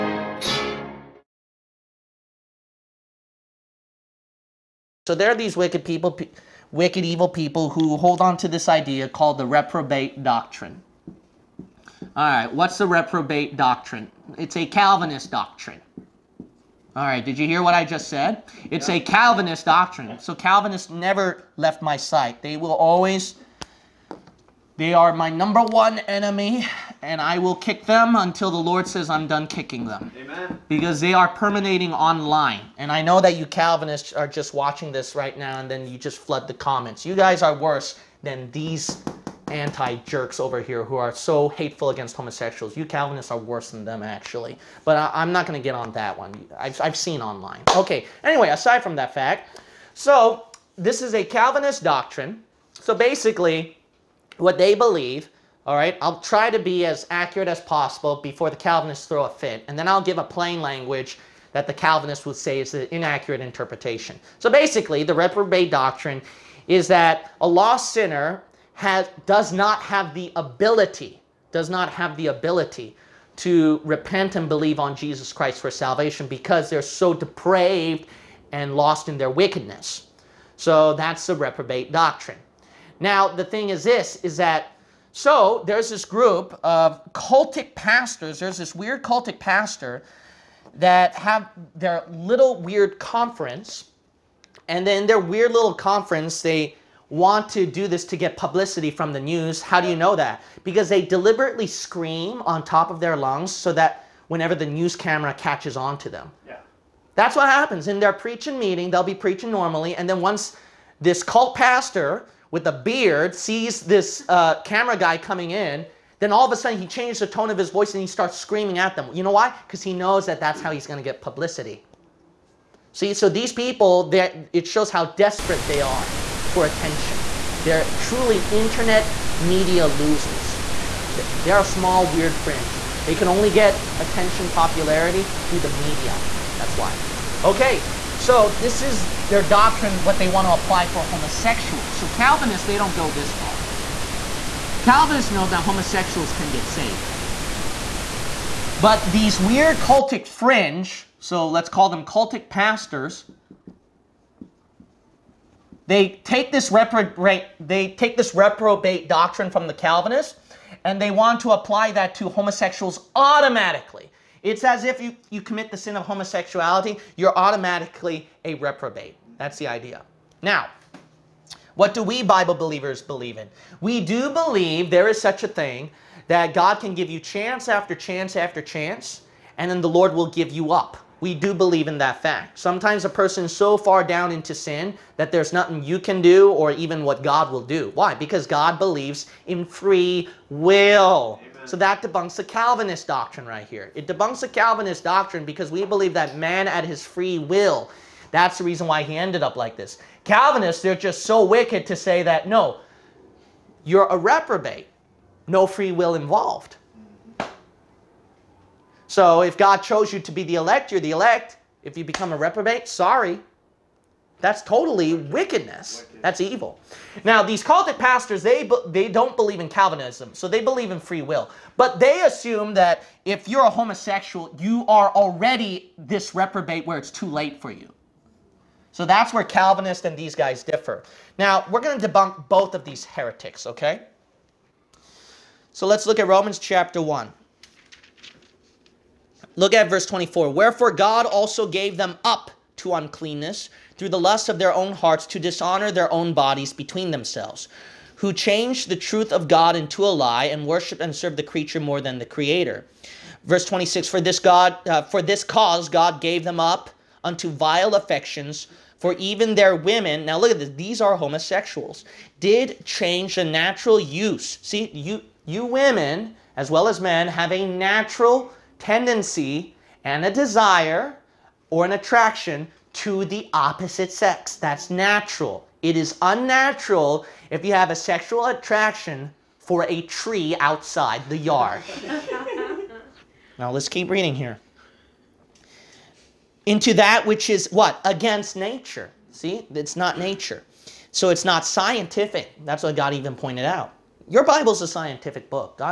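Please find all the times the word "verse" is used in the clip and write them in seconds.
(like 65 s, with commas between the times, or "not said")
239 s, 253 s.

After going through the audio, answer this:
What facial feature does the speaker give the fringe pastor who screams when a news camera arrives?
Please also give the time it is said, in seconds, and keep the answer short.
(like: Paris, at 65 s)
a beard, at 112 s.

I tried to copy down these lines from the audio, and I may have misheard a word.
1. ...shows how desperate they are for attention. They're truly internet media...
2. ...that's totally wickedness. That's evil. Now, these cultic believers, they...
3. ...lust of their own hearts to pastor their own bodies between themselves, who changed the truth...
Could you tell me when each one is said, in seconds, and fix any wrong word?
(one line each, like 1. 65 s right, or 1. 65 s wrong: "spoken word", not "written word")
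1. 124 s right
2. 214 s wrong: "pastors", not "believers"
3. 244 s wrong: "dishonor", not "pastor".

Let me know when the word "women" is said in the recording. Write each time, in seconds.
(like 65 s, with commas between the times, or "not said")
259 s, 265 s.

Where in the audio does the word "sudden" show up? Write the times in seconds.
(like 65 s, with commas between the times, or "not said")
116 s.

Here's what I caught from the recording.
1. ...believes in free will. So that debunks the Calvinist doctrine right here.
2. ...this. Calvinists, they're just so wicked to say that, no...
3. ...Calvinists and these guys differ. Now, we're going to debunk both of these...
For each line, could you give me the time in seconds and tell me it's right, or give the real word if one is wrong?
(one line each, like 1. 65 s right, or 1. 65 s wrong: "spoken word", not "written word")
1. 188 s right
2. 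199 s right
3. 229 s right.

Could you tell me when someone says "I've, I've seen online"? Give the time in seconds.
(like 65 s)
46 s.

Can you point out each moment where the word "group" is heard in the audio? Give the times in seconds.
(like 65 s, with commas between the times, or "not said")
86 s.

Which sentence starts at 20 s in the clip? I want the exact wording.
So Calvinists never left my sight.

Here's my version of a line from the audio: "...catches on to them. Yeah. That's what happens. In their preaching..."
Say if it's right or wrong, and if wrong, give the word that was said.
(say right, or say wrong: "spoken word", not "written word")
right.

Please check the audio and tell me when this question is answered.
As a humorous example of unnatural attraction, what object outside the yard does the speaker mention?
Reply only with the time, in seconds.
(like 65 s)
279 s.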